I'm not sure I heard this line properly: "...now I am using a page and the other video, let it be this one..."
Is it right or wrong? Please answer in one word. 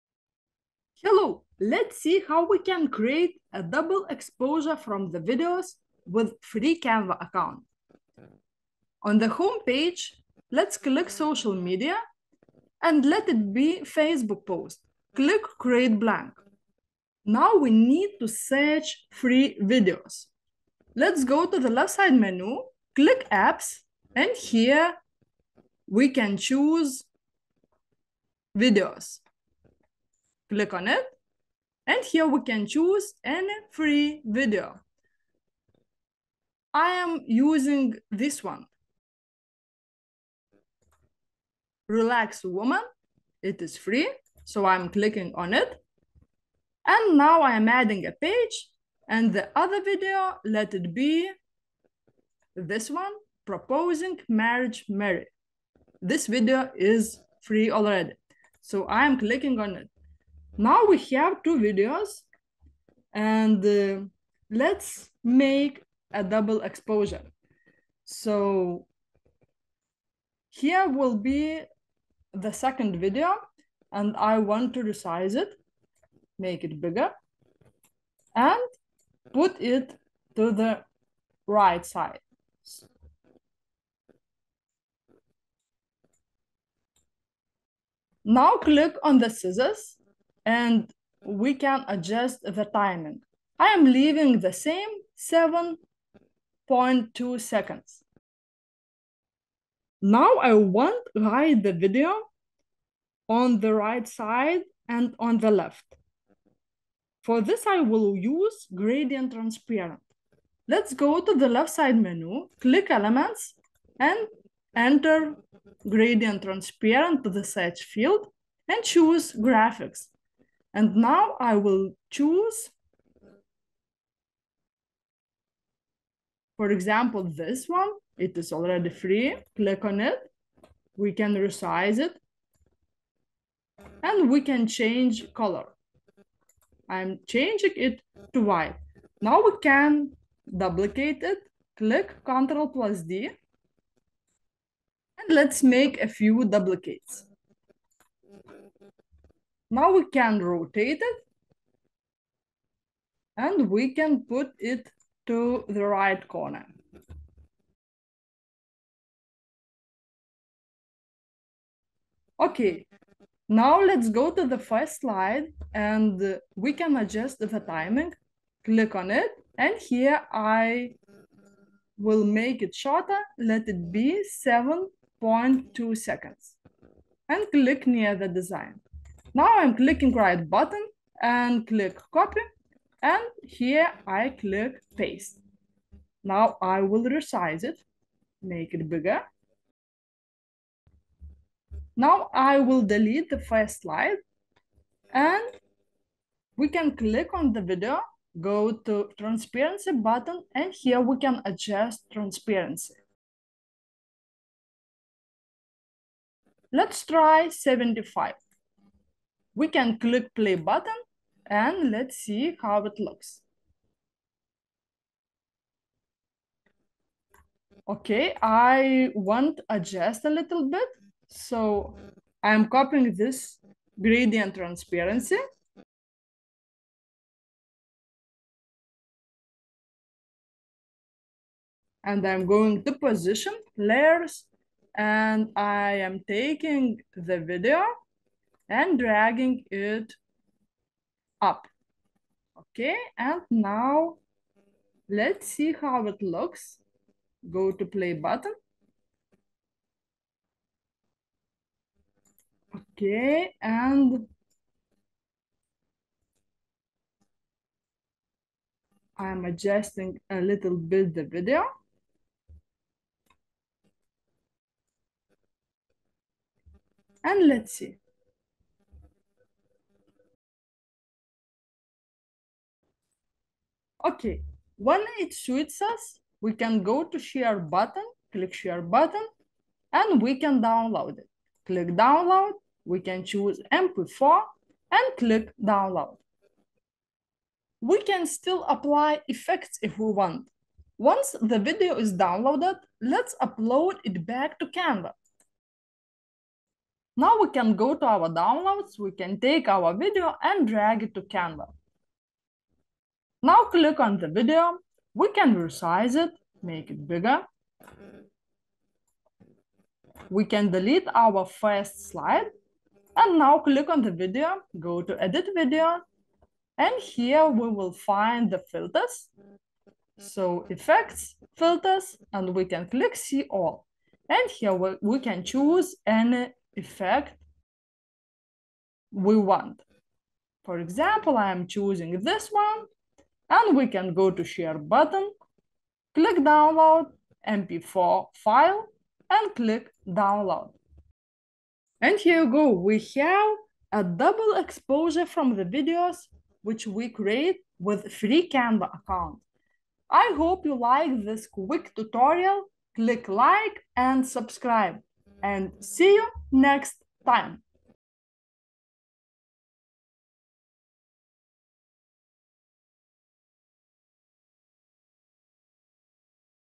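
wrong.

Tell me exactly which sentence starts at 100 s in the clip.
Now I want to hide the video on the right side and on the left.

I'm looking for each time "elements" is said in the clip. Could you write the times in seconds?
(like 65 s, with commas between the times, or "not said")
112 s.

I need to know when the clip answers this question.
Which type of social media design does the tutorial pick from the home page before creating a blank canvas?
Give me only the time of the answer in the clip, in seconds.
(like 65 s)
13 s.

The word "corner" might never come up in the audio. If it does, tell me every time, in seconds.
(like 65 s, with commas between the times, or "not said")
156 s.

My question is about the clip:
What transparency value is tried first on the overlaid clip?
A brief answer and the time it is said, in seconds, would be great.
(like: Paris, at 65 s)
75, at 207 s.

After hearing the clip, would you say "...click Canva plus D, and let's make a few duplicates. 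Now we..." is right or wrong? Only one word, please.
wrong.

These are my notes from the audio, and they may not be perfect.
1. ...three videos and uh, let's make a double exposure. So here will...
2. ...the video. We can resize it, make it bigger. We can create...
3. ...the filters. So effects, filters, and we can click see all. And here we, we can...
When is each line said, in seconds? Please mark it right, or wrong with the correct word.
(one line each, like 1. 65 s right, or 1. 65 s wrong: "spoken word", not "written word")
1. 61 s wrong: "two", not "three"
2. 304 s wrong: "delete", not "create"
3. 318 s right.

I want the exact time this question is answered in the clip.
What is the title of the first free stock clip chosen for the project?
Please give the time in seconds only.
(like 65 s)
41 s.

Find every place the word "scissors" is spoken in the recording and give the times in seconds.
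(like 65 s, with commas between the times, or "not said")
89 s.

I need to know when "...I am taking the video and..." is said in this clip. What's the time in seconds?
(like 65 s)
235 s.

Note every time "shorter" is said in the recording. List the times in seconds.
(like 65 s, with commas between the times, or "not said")
172 s.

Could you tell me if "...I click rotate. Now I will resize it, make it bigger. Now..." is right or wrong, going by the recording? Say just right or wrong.
wrong.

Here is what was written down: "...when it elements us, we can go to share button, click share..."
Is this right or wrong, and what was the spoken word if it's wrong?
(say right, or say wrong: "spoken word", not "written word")
wrong: "suits", not "elements".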